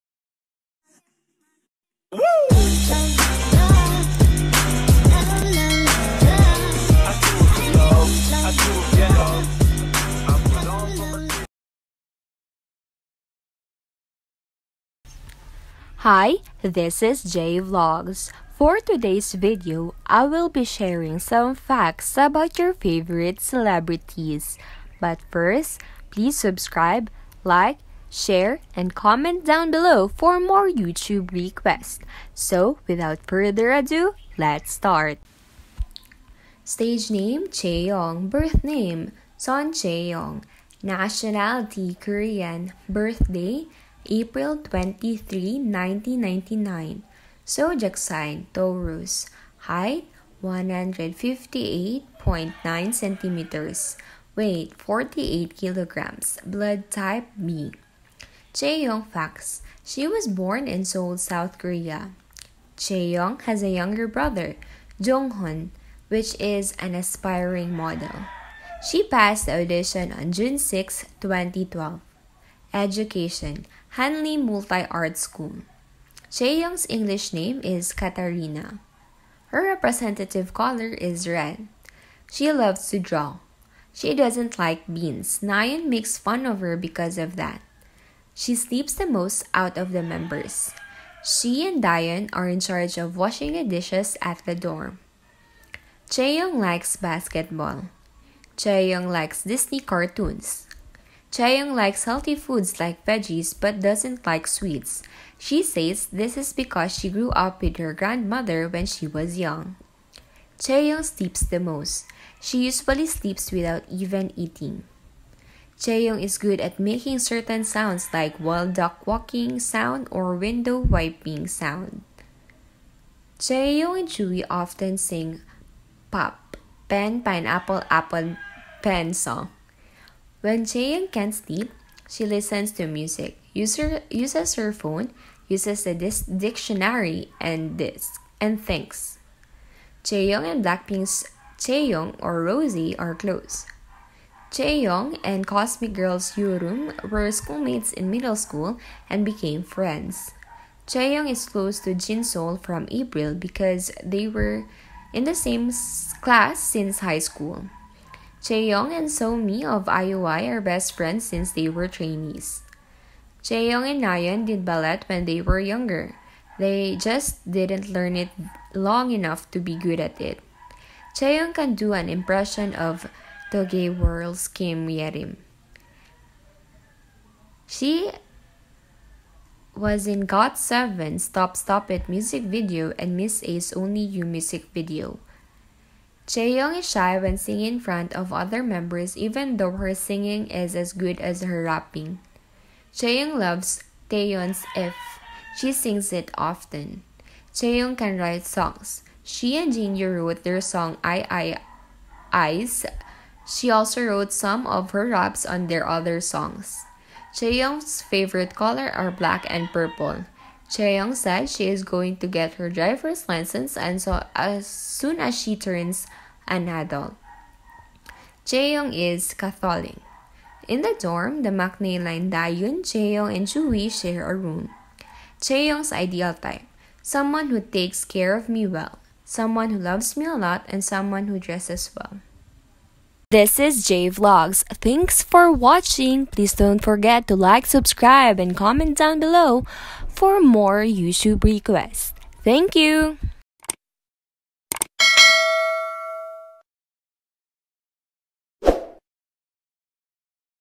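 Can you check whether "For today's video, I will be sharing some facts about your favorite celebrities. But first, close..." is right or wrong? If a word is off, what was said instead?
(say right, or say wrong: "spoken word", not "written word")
wrong: "please", not "close".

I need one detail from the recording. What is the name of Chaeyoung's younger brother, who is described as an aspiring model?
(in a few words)
Hun.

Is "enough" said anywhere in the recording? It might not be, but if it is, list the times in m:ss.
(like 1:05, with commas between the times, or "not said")
2:49.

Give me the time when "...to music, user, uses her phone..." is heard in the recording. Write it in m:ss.
2:12.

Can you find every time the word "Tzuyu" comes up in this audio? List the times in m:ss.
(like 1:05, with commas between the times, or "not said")
2:04, 3:43.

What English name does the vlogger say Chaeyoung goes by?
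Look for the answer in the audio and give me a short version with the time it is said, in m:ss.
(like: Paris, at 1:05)
Katarina, at 1:17.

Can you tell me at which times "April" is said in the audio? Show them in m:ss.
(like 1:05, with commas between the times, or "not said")
0:44, 2:32.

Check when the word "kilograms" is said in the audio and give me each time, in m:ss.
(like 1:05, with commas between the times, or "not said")
0:55.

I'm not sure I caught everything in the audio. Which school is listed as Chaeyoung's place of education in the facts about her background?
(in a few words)
Hanlim Multi Art School.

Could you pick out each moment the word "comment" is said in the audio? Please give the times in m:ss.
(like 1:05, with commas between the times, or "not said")
0:28, 3:58.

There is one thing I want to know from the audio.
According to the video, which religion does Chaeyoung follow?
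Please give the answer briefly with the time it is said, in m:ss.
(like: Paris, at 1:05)
Catholic, at 3:39.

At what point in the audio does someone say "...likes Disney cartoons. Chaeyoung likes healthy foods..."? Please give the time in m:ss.
1:39.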